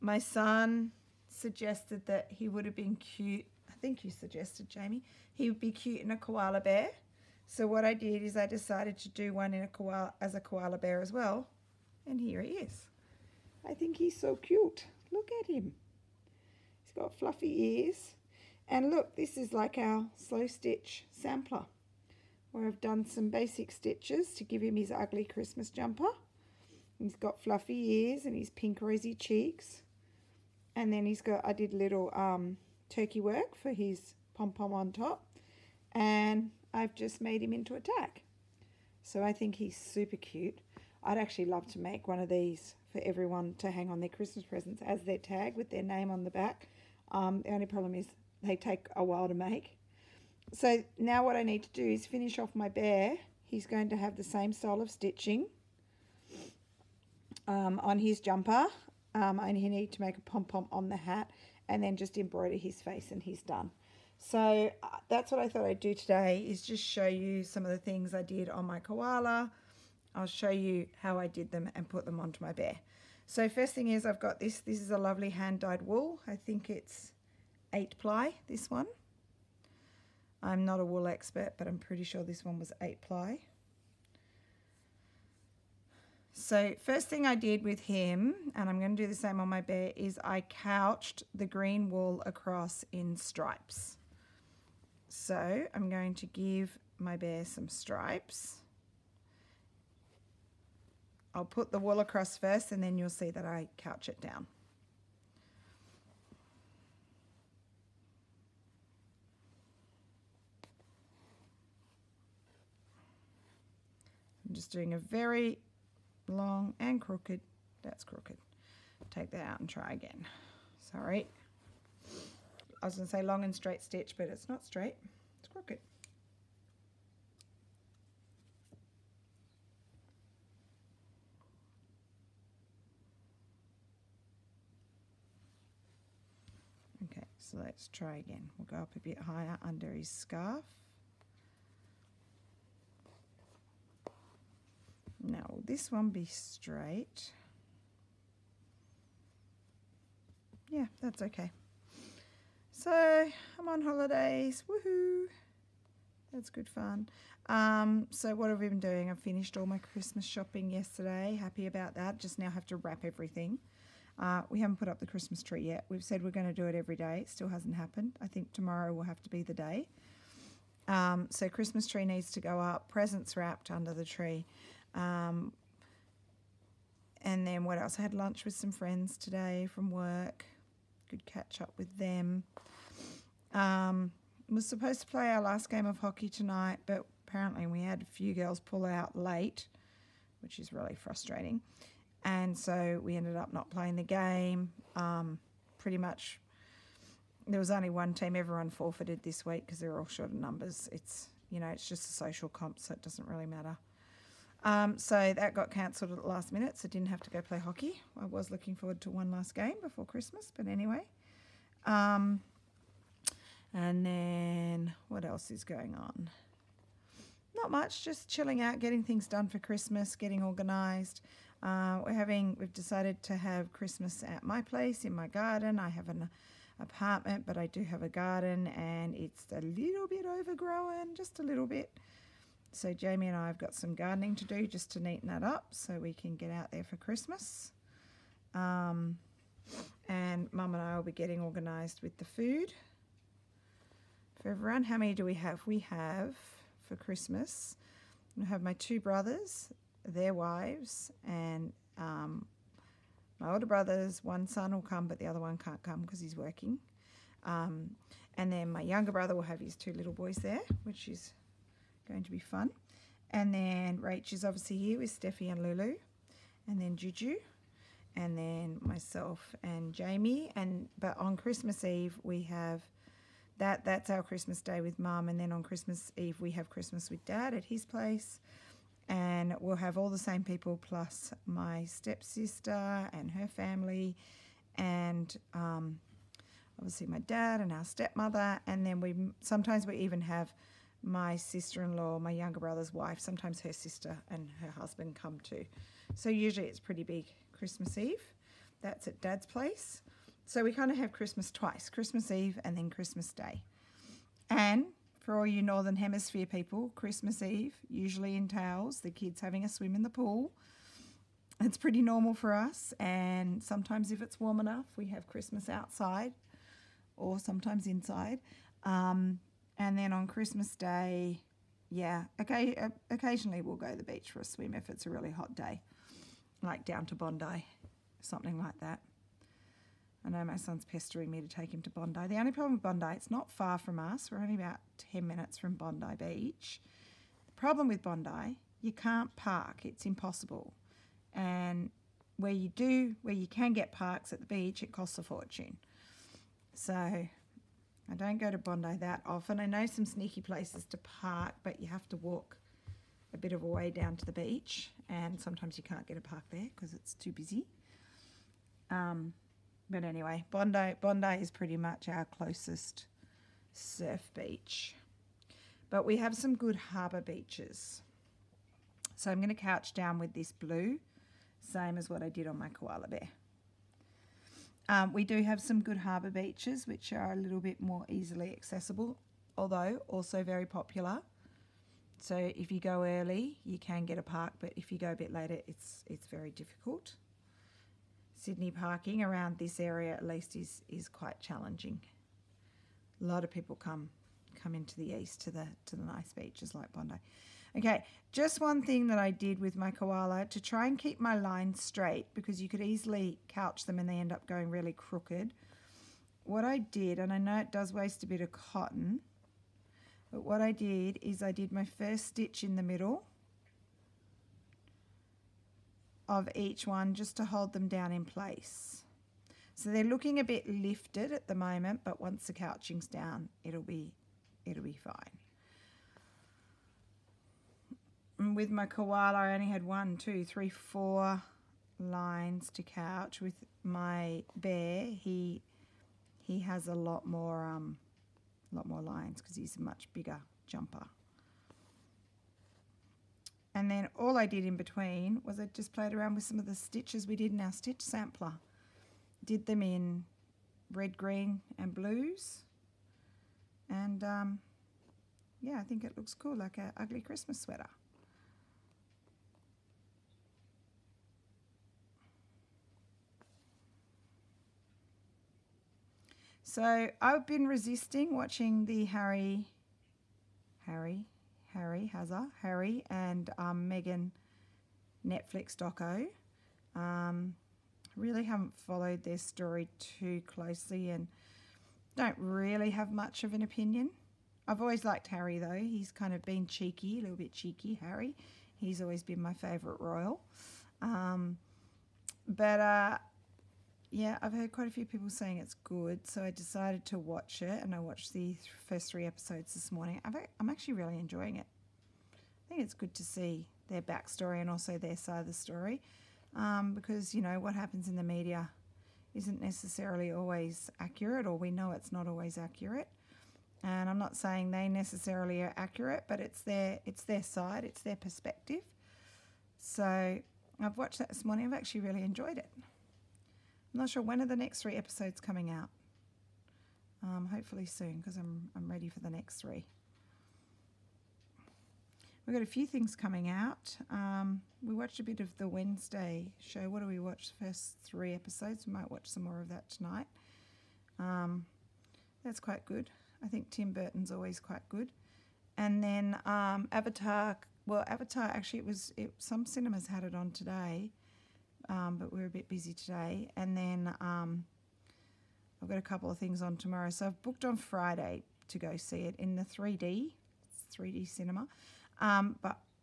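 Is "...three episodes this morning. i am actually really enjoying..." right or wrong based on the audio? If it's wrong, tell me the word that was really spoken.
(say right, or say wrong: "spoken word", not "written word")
right.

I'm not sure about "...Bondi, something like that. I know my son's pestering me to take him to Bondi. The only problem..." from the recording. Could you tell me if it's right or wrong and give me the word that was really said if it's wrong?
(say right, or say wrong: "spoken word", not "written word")
right.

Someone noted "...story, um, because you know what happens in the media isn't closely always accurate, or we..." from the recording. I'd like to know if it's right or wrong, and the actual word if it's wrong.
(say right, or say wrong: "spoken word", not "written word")
wrong: "necessarily", not "closely".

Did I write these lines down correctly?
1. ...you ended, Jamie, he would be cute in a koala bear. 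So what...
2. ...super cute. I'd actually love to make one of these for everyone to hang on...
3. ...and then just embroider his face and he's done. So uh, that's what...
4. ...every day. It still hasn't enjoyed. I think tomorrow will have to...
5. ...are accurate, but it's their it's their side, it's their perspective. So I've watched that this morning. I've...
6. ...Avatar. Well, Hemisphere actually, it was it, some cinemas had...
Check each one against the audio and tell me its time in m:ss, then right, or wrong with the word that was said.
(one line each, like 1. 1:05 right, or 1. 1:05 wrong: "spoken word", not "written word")
1. 0:04 wrong: "suggested", not "ended"
2. 0:39 right
3. 1:01 right
4. 2:46 wrong: "happened", not "enjoyed"
5. 8:35 right
6. 9:06 wrong: "Avatar", not "Hemisphere".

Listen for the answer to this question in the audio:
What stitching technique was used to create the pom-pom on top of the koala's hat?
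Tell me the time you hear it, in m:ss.
0:32.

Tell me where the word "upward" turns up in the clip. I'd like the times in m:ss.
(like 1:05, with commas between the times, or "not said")
not said.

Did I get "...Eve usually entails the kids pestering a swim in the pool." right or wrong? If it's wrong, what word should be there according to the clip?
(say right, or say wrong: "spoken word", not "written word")
wrong: "having", not "pestering".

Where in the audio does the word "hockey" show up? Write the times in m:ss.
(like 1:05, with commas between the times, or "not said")
3:05, 3:27.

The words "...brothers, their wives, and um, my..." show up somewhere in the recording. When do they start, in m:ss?
4:08.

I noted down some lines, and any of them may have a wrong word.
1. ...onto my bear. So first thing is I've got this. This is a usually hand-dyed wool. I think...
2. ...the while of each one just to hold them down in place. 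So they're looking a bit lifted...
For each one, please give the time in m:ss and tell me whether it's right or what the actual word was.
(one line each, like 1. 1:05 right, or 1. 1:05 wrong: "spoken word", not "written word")
1. 1:12 wrong: "lovely", not "usually"
2. 6:52 wrong: "middle", not "while".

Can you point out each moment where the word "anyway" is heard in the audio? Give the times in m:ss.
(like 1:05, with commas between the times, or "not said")
3:30, 6:00.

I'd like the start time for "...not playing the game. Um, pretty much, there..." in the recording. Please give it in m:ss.
3:13.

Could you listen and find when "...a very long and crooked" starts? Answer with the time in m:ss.
1:54.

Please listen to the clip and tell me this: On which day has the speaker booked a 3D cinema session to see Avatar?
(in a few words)
Friday.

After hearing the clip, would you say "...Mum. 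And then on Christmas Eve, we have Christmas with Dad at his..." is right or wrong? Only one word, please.
right.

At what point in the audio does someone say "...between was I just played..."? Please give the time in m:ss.
7:24.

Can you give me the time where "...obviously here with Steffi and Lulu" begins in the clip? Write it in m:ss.
4:24.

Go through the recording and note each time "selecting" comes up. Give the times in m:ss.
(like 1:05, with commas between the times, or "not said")
not said.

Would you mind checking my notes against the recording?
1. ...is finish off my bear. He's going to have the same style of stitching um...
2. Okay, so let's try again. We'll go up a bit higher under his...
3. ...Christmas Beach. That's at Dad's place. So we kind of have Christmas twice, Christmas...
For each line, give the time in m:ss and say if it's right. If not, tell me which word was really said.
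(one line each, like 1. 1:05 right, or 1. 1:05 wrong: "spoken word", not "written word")
1. 0:51 right
2. 2:17 right
3. 4:57 wrong: "Eve", not "Beach".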